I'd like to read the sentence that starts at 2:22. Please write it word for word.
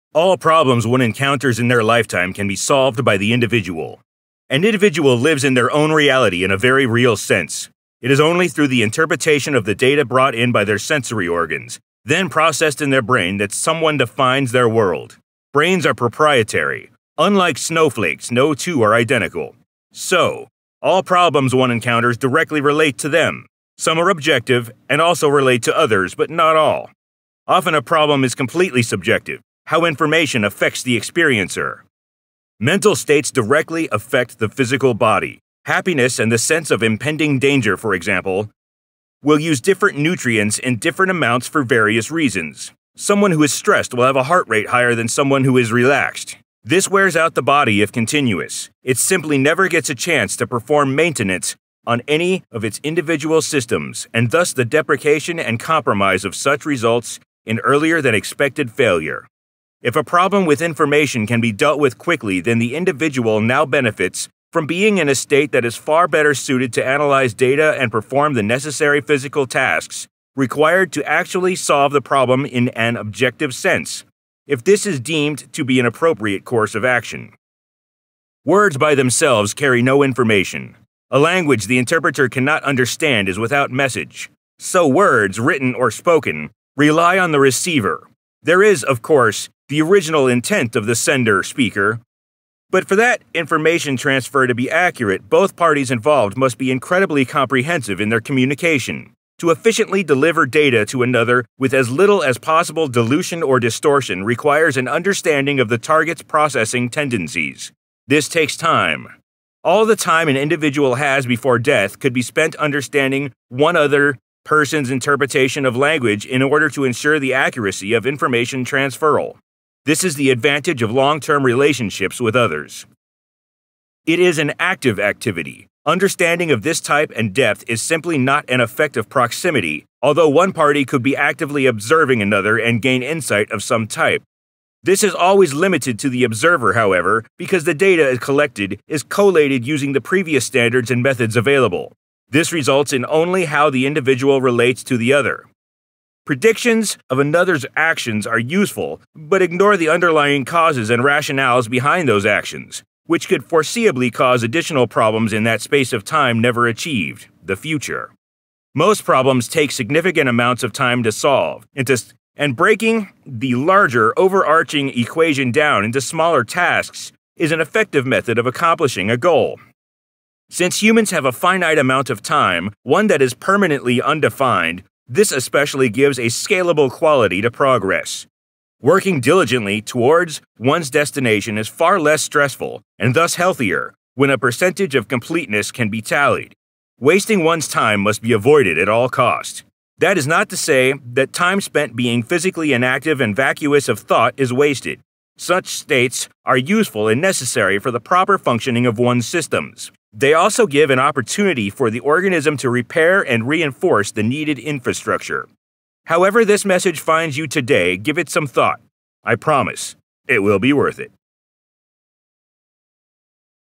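This results in only how the individual relates to the other.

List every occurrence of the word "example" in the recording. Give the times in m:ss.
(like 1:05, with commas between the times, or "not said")
0:37.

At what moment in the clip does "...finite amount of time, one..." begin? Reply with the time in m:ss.
2:51.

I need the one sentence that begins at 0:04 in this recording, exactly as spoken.
An individual lives in their own reality in a very real sense.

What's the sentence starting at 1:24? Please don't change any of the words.
So words, written or spoken, rely on the receiver.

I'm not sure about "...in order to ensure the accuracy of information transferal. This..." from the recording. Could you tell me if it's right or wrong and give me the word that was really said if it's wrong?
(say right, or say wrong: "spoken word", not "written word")
right.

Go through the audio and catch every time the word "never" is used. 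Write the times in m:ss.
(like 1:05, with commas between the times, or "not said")
0:49, 2:36.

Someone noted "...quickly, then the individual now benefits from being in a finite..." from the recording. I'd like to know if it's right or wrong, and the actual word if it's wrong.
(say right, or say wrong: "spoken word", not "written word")
wrong: "state", not "finite".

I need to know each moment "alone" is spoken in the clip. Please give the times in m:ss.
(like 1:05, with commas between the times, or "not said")
not said.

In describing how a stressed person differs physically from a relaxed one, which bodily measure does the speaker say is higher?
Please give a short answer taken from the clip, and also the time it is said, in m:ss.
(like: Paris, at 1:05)
heart rate, at 0:44.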